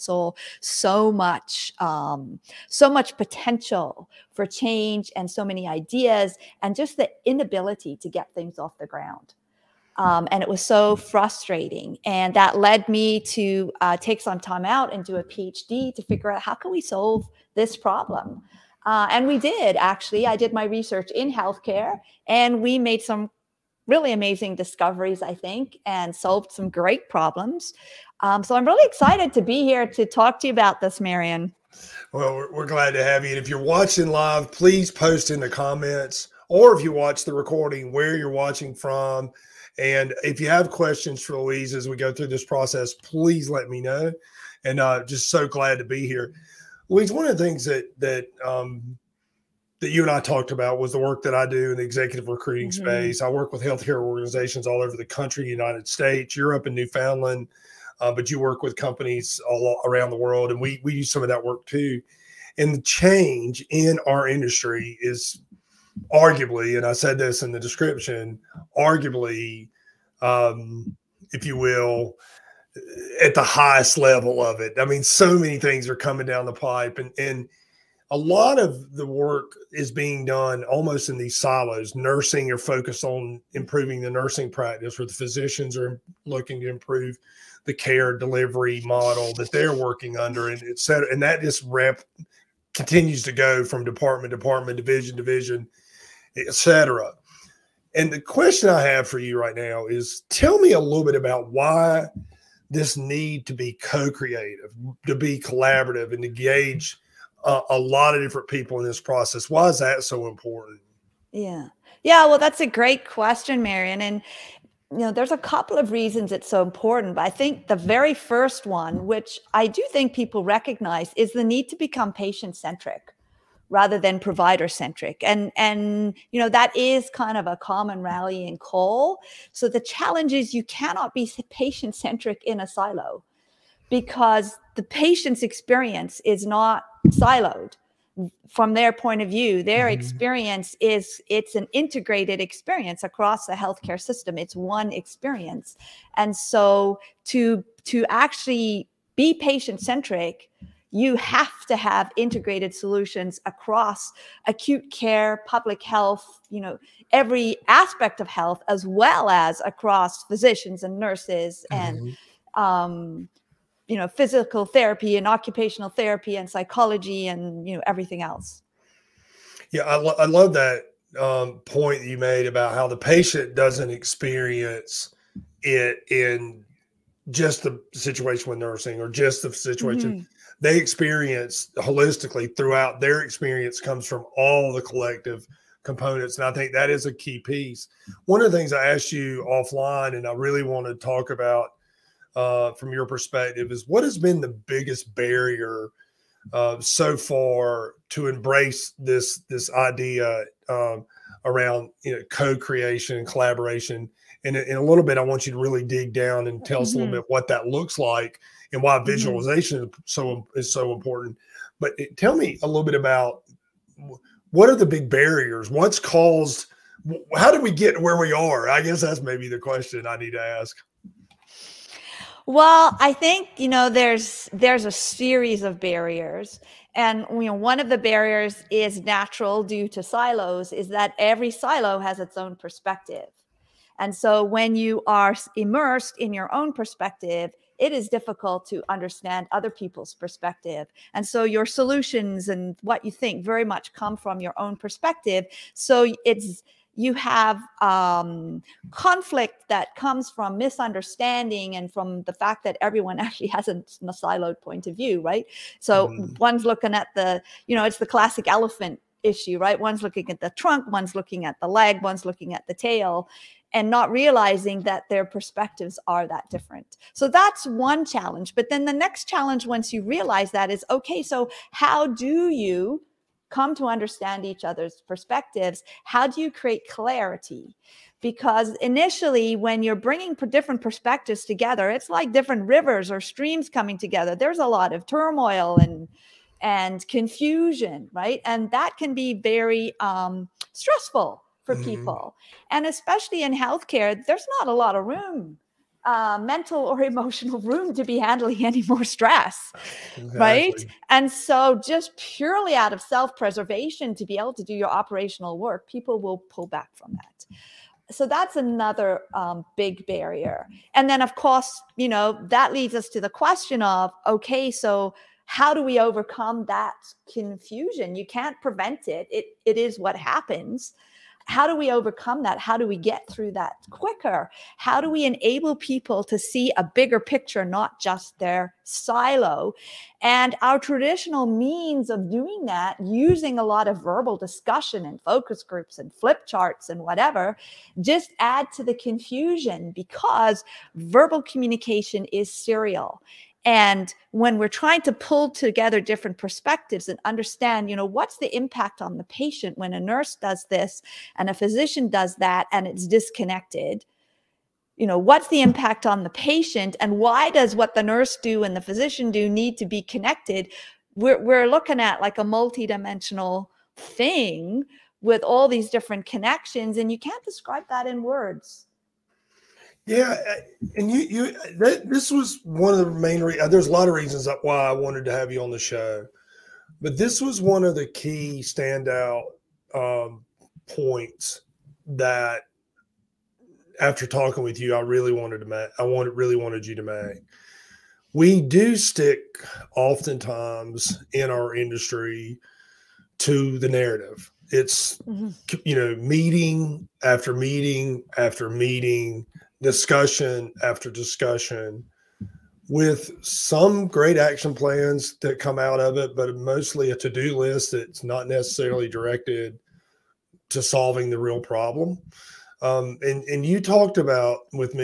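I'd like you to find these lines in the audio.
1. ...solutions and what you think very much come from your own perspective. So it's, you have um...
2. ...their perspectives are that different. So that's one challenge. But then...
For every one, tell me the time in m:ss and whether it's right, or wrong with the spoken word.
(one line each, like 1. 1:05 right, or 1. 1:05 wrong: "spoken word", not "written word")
1. 4:01 right
2. 4:25 right.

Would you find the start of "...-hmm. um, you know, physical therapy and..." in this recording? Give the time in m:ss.
2:42.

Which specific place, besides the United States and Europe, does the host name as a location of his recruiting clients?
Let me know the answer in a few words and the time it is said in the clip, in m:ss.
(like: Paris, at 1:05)
Newfoundland, at 0:56.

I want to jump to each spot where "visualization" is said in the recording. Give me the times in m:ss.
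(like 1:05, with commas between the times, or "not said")
3:29.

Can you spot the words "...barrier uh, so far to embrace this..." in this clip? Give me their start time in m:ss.
3:15.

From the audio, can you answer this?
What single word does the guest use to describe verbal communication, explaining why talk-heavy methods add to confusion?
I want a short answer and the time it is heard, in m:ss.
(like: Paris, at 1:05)
serial, at 5:42.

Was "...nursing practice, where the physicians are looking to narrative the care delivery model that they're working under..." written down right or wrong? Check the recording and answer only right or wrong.
wrong.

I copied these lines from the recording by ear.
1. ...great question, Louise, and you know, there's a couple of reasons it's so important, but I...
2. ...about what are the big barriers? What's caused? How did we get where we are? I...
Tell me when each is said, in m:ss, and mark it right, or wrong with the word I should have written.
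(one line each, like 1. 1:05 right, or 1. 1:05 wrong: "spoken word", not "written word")
1. 1:52 wrong: "Marion", not "Louise"
2. 3:32 right.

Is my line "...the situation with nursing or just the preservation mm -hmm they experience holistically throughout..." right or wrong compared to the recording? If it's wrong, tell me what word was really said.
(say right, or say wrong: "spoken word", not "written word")
wrong: "situation", not "preservation".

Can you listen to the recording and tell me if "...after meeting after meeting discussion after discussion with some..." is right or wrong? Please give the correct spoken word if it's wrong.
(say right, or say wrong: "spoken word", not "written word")
right.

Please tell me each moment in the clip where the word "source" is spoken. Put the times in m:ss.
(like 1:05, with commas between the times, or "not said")
not said.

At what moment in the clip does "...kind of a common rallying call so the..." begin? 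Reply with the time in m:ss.
2:07.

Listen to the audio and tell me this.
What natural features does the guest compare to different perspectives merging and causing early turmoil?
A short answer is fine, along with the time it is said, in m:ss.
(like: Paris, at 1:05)
rivers or streams, at 4:42.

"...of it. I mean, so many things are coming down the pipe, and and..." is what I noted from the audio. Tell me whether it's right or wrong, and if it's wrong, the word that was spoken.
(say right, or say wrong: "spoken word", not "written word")
right.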